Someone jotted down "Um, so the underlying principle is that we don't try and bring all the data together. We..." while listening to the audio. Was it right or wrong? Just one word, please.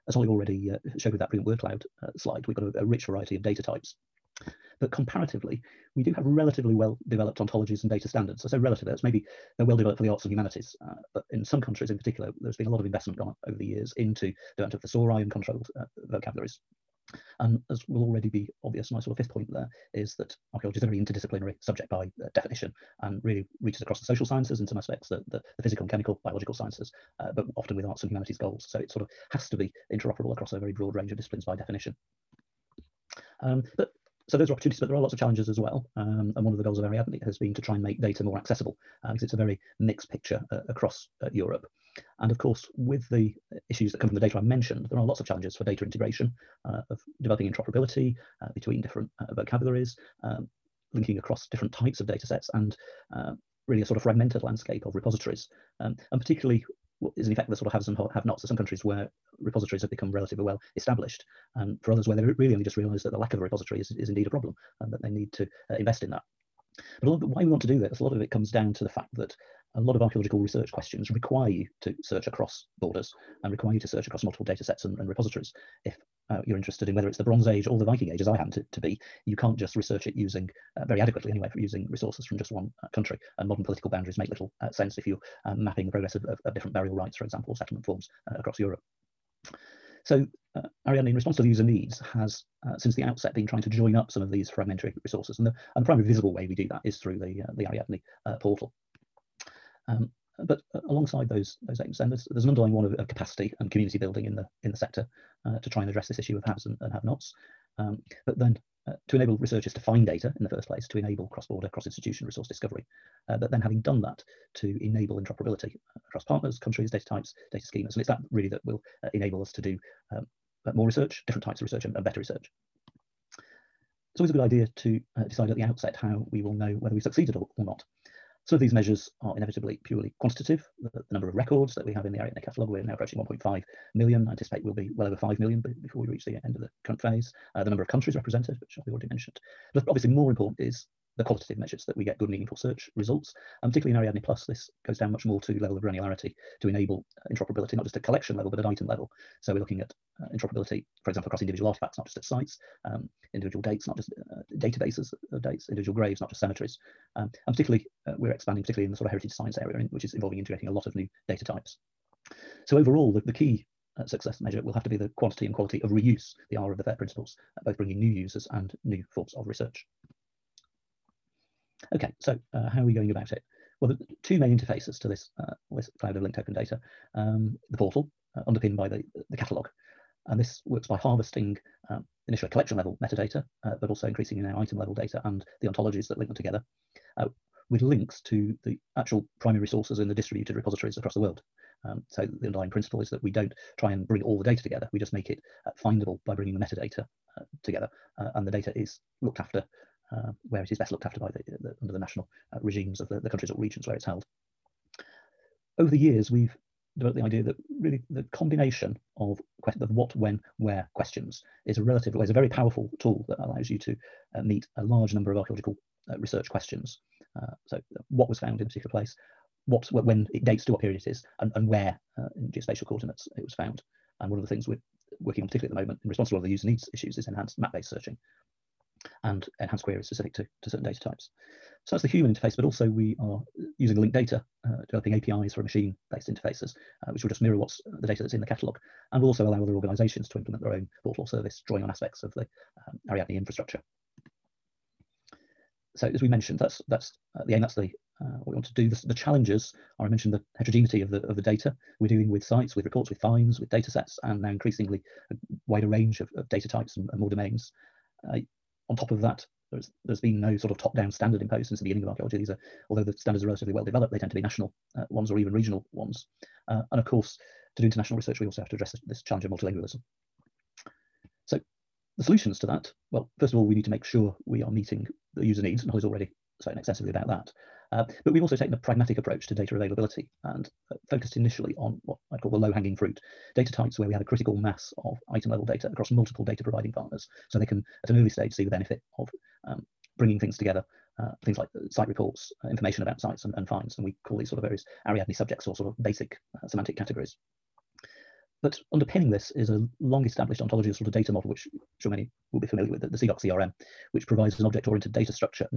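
right.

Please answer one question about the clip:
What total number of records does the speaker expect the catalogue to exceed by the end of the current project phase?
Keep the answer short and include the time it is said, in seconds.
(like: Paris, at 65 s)
5 million, at 135 s.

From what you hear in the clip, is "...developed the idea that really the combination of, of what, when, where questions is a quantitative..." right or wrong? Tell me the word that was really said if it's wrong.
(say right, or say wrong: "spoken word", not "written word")
wrong: "relative", not "quantitative".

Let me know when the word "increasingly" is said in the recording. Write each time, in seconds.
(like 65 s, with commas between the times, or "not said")
184 s, 254 s.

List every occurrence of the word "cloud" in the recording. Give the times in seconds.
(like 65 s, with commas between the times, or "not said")
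1 s, 175 s.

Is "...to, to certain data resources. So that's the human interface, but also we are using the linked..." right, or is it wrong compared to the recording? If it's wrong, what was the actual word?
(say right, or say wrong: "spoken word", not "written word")
wrong: "types", not "resources".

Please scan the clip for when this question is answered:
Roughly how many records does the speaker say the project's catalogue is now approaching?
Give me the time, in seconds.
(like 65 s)
133 s.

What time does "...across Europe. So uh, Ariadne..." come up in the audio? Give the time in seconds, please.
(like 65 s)
88 s.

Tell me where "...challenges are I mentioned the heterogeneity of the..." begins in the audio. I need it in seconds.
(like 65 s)
249 s.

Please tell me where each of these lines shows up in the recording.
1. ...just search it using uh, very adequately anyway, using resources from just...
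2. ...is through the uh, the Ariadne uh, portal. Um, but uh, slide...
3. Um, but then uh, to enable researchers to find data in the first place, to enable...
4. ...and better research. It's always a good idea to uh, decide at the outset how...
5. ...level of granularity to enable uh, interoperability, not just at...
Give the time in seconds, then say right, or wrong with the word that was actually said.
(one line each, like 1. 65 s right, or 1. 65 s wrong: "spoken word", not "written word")
1. 79 s wrong: "research", not "search"
2. 96 s wrong: "alongside", not "slide"
3. 107 s right
4. 121 s right
5. 145 s right.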